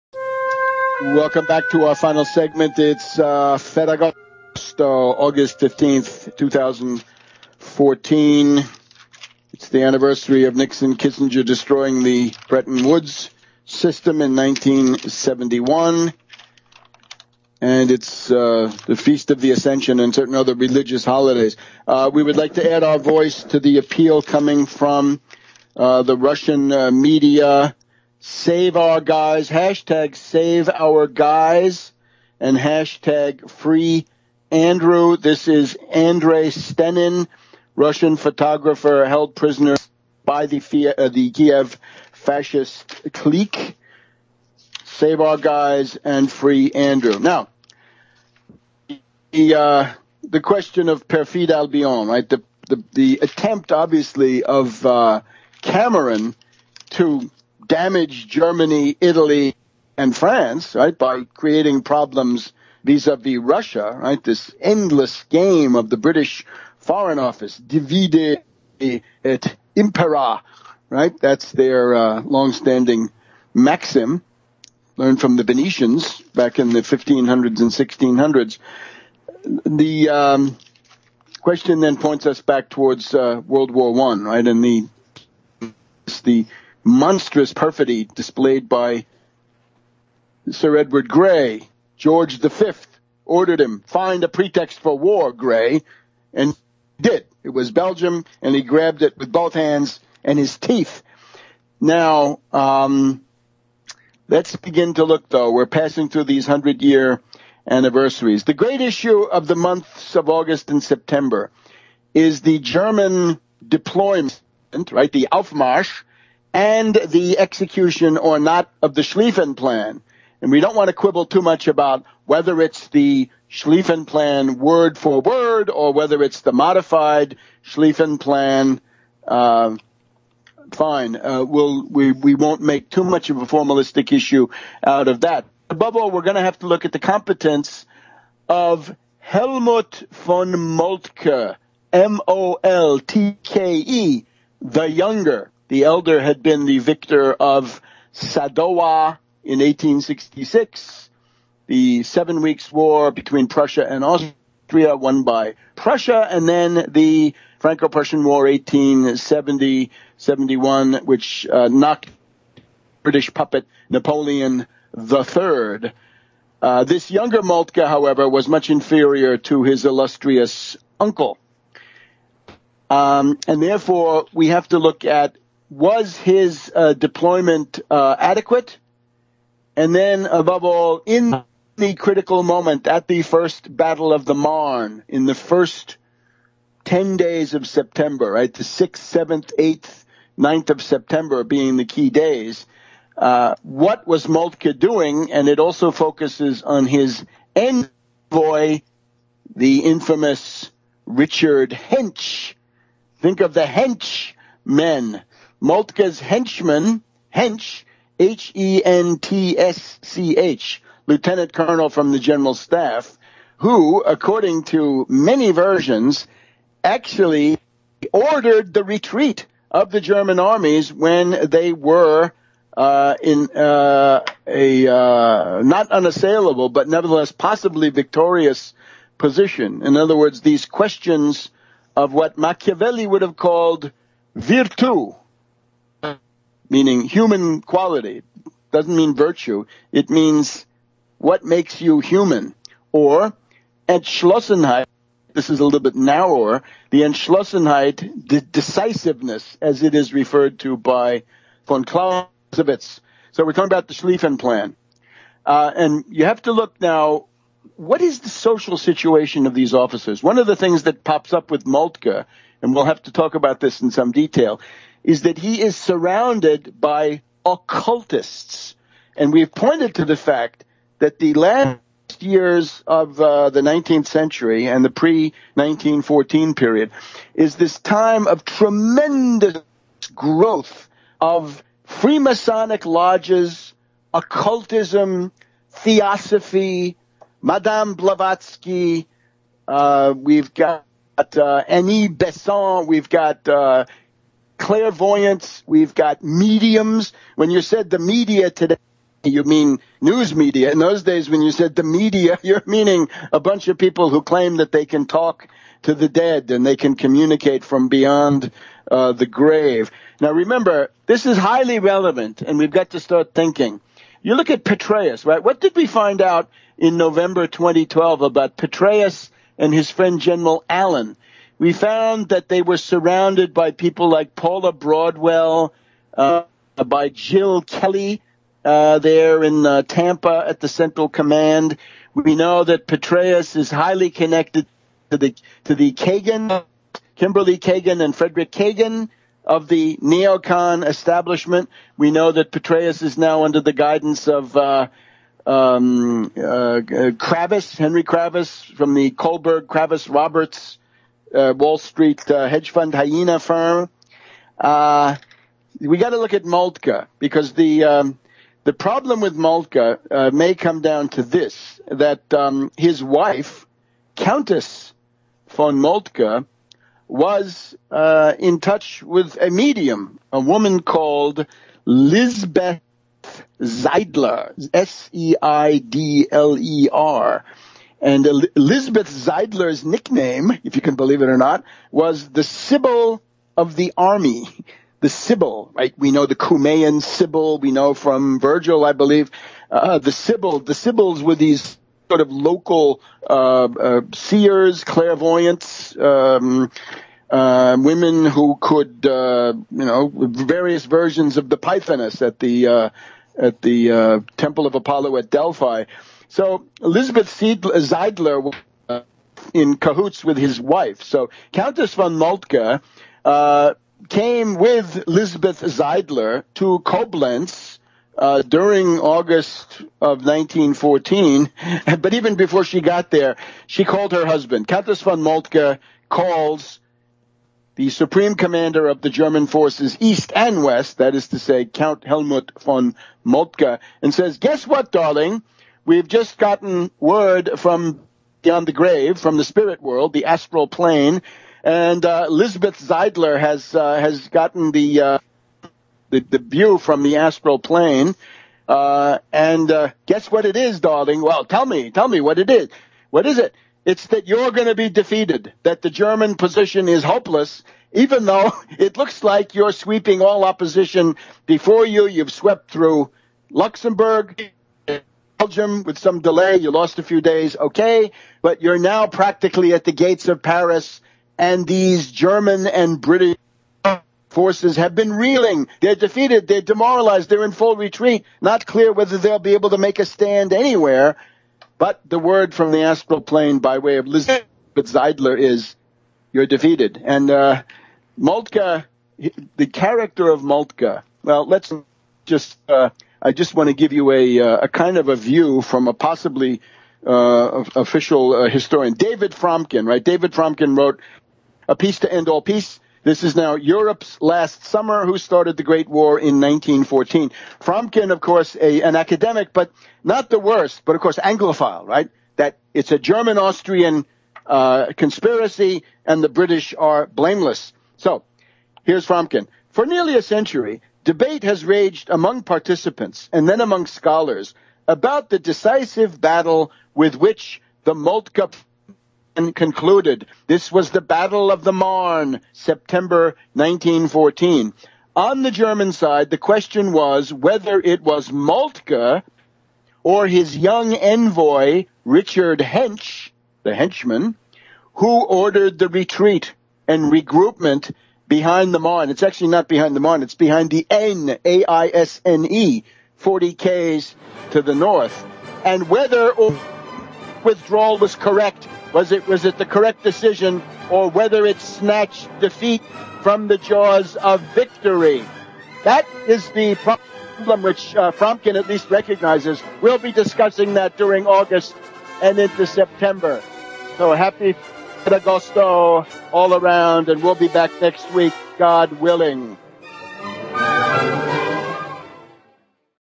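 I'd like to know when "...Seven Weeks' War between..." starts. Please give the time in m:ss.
2:32.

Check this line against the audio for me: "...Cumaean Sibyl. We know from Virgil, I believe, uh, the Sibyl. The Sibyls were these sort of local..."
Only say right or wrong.
right.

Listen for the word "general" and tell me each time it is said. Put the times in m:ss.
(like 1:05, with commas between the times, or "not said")
3:32, 5:20.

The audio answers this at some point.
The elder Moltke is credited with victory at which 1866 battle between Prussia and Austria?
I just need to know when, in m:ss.
2:28.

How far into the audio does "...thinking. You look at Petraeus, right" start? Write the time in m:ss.
5:13.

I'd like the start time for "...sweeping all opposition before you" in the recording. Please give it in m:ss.
7:39.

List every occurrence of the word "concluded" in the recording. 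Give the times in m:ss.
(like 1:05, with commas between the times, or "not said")
8:49.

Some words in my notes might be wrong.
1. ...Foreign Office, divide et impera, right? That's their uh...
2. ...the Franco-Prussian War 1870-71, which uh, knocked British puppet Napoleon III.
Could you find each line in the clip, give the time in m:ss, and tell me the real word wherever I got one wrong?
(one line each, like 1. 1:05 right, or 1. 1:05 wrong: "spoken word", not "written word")
1. 1:06 right
2. 2:36 right.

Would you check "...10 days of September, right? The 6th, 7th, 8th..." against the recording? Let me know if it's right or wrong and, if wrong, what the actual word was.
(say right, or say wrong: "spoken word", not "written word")
right.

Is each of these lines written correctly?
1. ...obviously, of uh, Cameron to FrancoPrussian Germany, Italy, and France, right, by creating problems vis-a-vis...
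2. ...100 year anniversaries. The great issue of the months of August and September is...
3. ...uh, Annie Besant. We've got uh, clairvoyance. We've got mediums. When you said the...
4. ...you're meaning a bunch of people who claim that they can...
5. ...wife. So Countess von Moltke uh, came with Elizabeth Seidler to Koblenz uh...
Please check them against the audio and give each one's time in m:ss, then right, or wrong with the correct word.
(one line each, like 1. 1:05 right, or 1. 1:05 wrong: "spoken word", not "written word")
1. 0:53 wrong: "Damage", not "FrancoPrussian"
2. 1:46 right
3. 4:51 right
4. 5:02 right
5. 6:50 right.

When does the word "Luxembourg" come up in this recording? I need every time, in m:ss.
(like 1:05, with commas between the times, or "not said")
7:43.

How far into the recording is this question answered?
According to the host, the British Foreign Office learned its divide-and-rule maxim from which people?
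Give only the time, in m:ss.
1:15.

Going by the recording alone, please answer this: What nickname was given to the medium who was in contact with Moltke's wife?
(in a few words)
The Sibyl of the Army.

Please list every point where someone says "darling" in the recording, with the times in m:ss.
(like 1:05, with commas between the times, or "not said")
7:14, 7:30.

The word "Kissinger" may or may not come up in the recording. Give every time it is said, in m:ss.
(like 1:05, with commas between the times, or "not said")
0:10.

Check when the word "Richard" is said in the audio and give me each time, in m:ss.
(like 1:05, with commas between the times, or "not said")
3:21, 9:02.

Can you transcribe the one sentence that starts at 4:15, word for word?
Uh, and you have to look now, what is the social situation of these officers?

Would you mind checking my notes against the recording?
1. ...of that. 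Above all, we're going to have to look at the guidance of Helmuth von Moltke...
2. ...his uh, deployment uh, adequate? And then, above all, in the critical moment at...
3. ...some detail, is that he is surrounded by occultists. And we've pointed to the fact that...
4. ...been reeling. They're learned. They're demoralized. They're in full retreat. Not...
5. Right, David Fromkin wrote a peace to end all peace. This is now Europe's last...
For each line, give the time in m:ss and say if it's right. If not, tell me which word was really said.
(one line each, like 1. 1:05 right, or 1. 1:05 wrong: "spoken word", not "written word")
1. 2:15 wrong: "competence", not "guidance"
2. 2:56 right
3. 4:23 right
4. 7:54 wrong: "defeated", not "learned"
5. 8:19 right.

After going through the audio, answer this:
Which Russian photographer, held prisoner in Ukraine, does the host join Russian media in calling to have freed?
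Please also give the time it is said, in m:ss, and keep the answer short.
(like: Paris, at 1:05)
Andrei Stenin, at 0:35.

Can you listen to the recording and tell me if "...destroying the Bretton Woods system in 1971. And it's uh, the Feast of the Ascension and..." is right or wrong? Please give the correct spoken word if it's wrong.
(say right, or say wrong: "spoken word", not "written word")
right.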